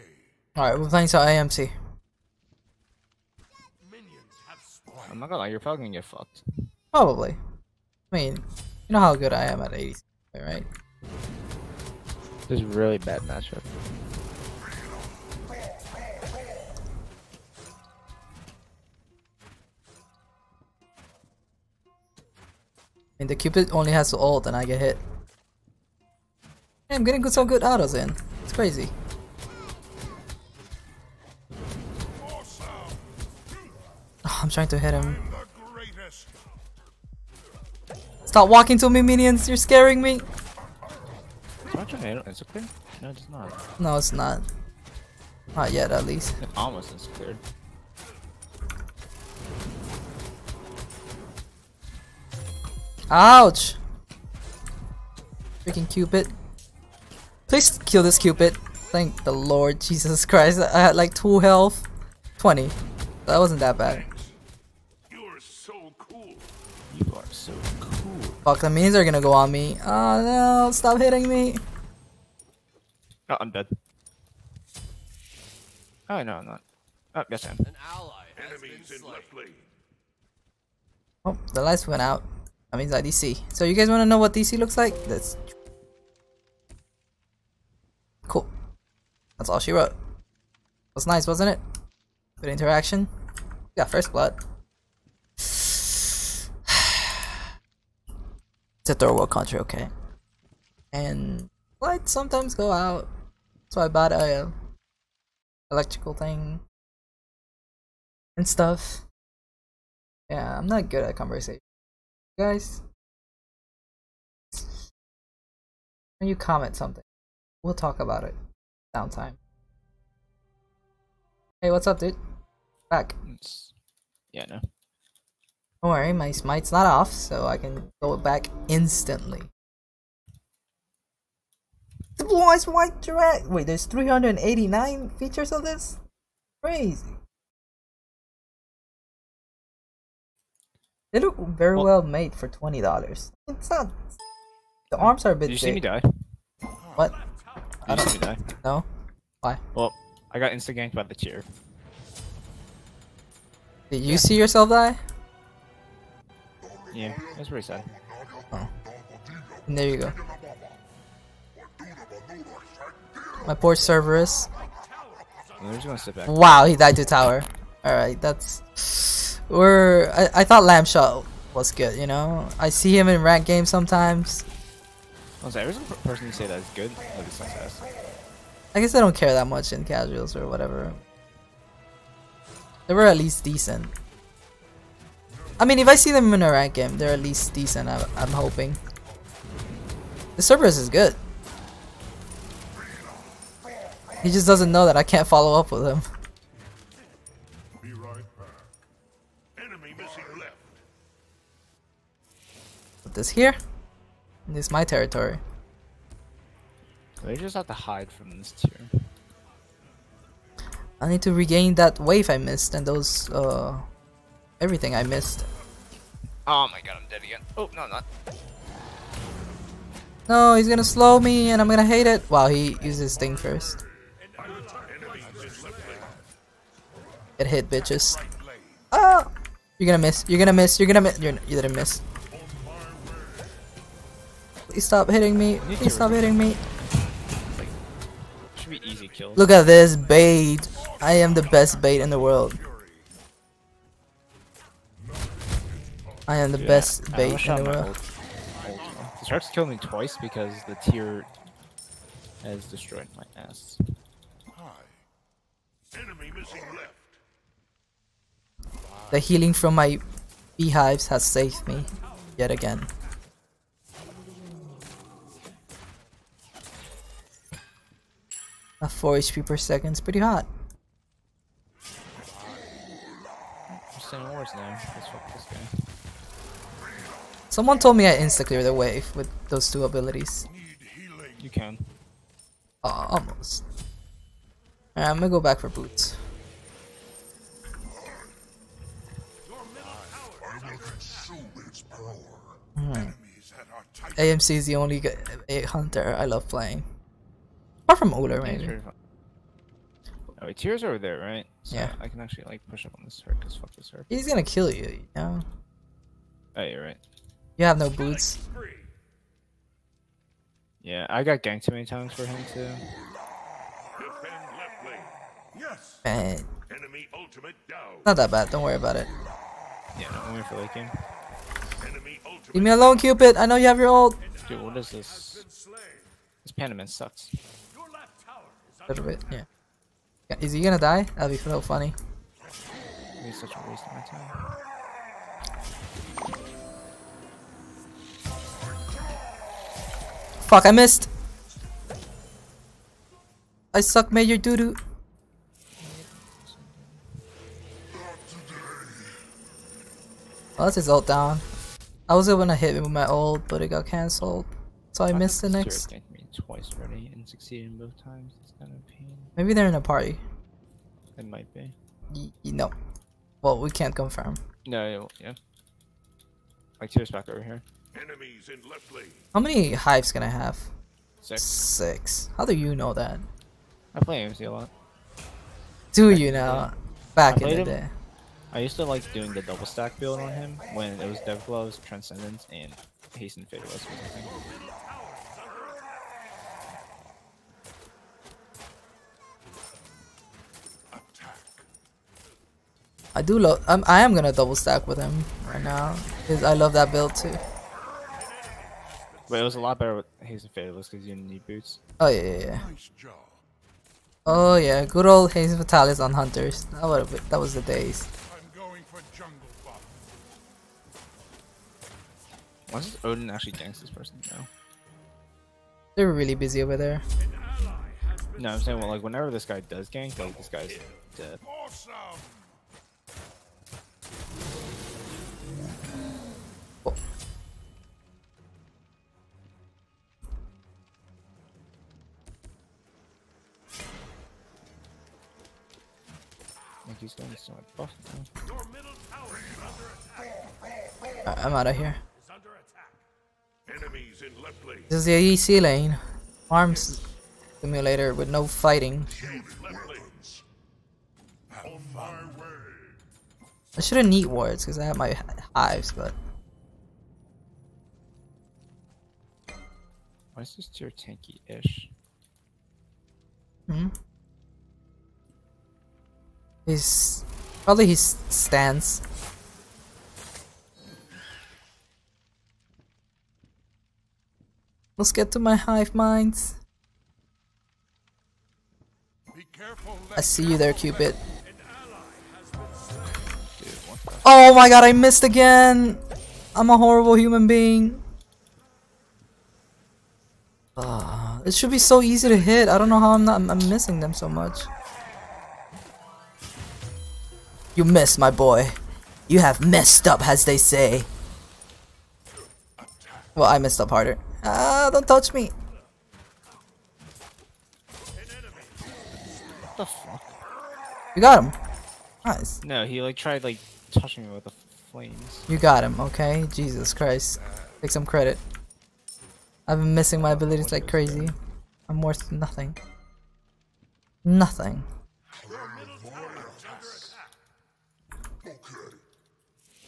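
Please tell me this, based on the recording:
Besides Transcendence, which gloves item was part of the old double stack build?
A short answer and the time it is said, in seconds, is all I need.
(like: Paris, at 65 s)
Dev Gloves, at 381 s.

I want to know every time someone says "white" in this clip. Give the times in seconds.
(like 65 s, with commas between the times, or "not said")
132 s.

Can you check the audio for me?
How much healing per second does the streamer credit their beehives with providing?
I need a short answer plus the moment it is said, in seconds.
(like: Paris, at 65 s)
4 HP, at 268 s.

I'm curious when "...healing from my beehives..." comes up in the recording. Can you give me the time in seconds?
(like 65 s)
259 s.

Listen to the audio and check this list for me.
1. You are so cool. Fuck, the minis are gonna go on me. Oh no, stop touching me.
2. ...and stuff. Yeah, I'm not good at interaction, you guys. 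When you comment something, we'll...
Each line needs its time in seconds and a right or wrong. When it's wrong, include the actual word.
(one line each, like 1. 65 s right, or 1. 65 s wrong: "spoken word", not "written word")
1. 66 s wrong: "hitting", not "touching"
2. 108 s wrong: "conversation", not "interaction".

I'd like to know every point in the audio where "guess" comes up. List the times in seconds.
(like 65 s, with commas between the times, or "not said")
178 s.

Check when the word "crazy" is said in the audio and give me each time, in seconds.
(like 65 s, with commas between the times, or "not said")
28 s, 136 s, 520 s.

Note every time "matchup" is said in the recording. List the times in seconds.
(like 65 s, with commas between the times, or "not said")
13 s.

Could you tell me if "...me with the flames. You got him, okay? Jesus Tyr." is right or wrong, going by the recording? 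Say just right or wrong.
wrong.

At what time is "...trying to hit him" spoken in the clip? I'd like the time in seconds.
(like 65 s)
34 s.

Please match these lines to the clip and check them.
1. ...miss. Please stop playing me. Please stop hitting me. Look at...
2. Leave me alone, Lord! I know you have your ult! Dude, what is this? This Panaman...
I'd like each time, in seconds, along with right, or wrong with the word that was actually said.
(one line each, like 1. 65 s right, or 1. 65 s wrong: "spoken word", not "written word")
1. 231 s wrong: "hitting", not "playing"
2. 322 s wrong: "Cupid", not "Lord".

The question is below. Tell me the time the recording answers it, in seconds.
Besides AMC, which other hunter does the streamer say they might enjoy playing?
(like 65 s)
298 s.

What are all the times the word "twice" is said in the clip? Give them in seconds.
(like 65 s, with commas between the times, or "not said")
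249 s, 356 s.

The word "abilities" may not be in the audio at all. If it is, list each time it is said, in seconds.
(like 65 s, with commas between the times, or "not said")
279 s, 520 s.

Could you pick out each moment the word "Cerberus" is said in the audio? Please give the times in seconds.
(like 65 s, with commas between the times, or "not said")
163 s, 190 s.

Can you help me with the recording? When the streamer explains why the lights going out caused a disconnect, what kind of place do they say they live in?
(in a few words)
third world country.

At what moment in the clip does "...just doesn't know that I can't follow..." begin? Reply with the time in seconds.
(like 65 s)
194 s.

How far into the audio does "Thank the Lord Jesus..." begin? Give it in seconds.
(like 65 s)
58 s.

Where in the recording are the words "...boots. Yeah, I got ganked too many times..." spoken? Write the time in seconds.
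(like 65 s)
307 s.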